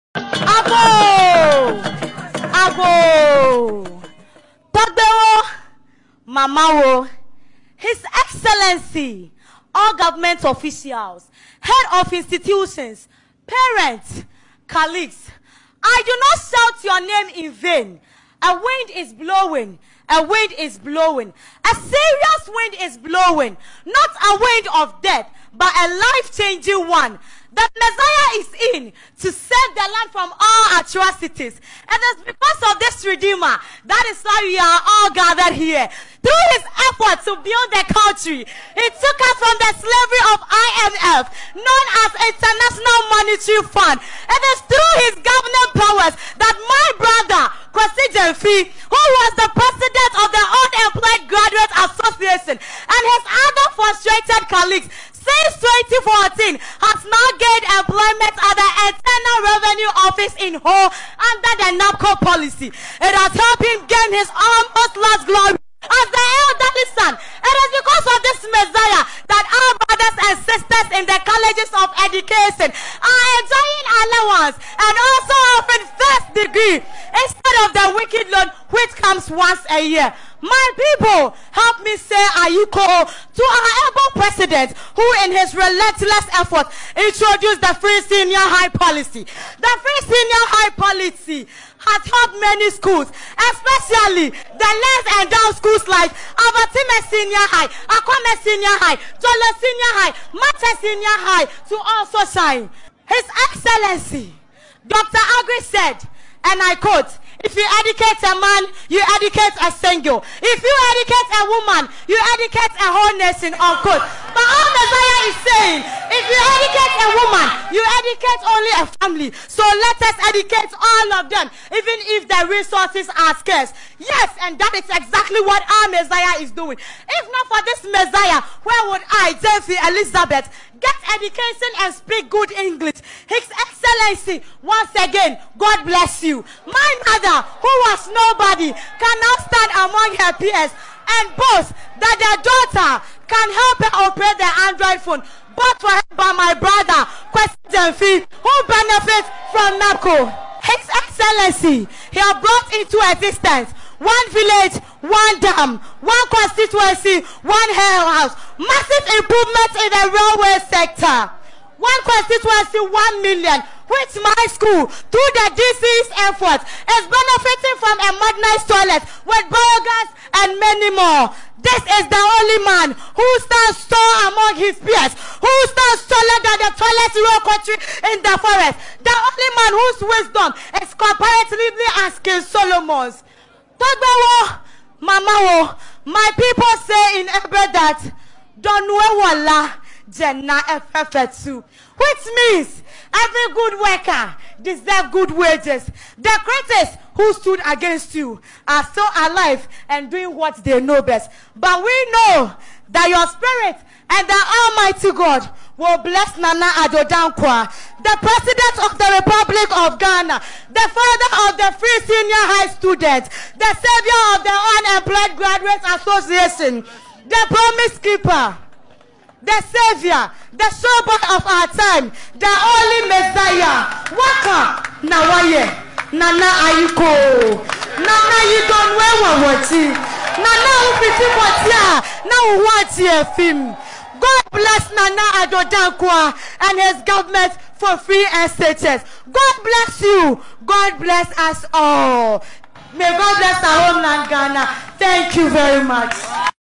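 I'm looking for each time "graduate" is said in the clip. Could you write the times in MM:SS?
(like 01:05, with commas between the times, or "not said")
00:51, 03:35.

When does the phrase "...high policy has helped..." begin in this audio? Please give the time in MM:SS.
01:30.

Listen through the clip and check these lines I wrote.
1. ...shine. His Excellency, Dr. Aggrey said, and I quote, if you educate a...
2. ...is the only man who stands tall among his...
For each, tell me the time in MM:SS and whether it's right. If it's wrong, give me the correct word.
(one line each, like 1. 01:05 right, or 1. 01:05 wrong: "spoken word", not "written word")
1. 01:42 right
2. 02:52 right.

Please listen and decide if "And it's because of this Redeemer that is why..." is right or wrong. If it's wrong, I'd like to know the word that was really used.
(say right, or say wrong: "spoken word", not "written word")
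right.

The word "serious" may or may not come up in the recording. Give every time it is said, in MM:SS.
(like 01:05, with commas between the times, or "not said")
00:21.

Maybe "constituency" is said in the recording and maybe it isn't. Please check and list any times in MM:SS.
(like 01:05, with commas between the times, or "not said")
02:36, 02:42.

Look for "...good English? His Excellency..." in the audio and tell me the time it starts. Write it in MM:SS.
02:12.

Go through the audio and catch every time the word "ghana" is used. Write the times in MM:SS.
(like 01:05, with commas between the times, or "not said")
03:29, 04:04.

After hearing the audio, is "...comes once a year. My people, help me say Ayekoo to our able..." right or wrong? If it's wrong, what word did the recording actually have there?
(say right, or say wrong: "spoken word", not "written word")
right.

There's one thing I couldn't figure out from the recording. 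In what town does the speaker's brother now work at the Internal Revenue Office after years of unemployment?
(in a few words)
Ho.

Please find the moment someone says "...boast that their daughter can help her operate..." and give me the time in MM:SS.
02:21.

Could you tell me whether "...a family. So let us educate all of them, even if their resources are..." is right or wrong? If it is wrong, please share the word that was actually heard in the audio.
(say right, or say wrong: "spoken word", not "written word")
right.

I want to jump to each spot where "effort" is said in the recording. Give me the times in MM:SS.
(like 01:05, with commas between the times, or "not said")
00:36, 01:26, 02:46.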